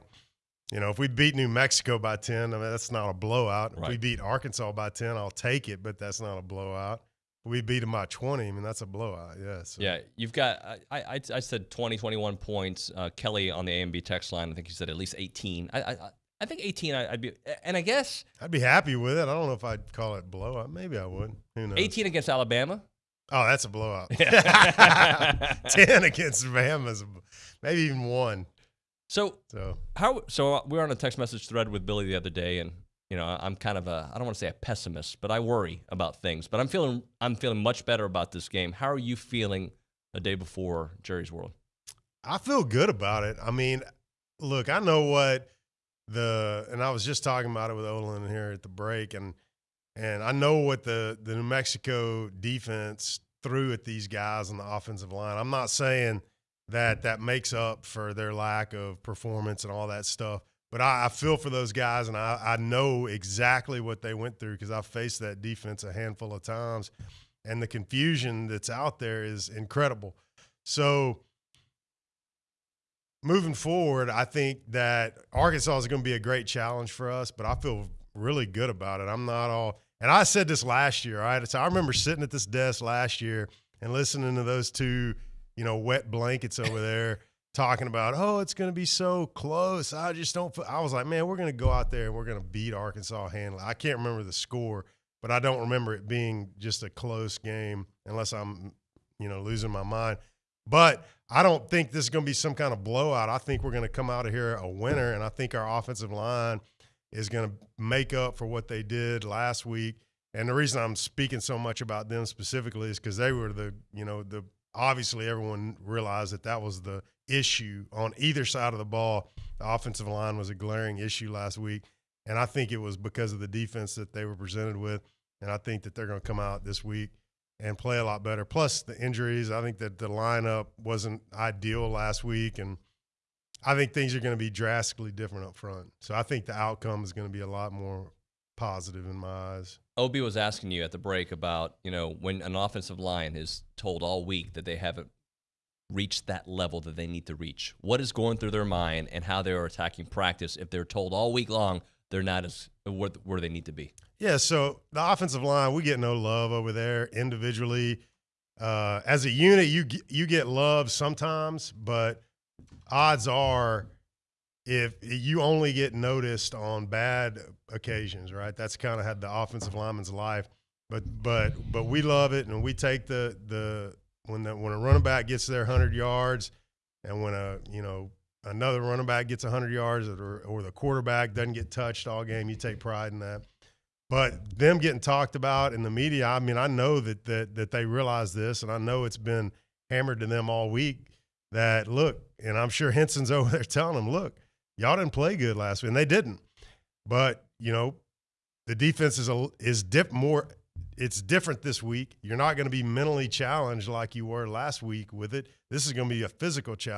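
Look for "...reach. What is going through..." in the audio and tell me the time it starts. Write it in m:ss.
2:27.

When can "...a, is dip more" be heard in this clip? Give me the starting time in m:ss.
3:19.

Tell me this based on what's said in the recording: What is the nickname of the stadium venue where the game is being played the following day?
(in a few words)
Jerry's World.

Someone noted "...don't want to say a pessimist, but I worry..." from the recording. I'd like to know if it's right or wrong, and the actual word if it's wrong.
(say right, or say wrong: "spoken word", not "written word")
right.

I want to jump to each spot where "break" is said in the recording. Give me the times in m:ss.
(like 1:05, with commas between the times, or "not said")
0:48, 2:20.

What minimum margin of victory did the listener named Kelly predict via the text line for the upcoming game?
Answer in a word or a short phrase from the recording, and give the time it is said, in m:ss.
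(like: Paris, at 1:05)
18, at 0:14.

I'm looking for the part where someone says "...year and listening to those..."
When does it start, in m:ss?
1:23.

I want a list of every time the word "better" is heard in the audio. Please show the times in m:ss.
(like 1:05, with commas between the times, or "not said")
0:37, 2:08.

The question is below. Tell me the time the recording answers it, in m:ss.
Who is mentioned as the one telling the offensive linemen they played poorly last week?
3:12.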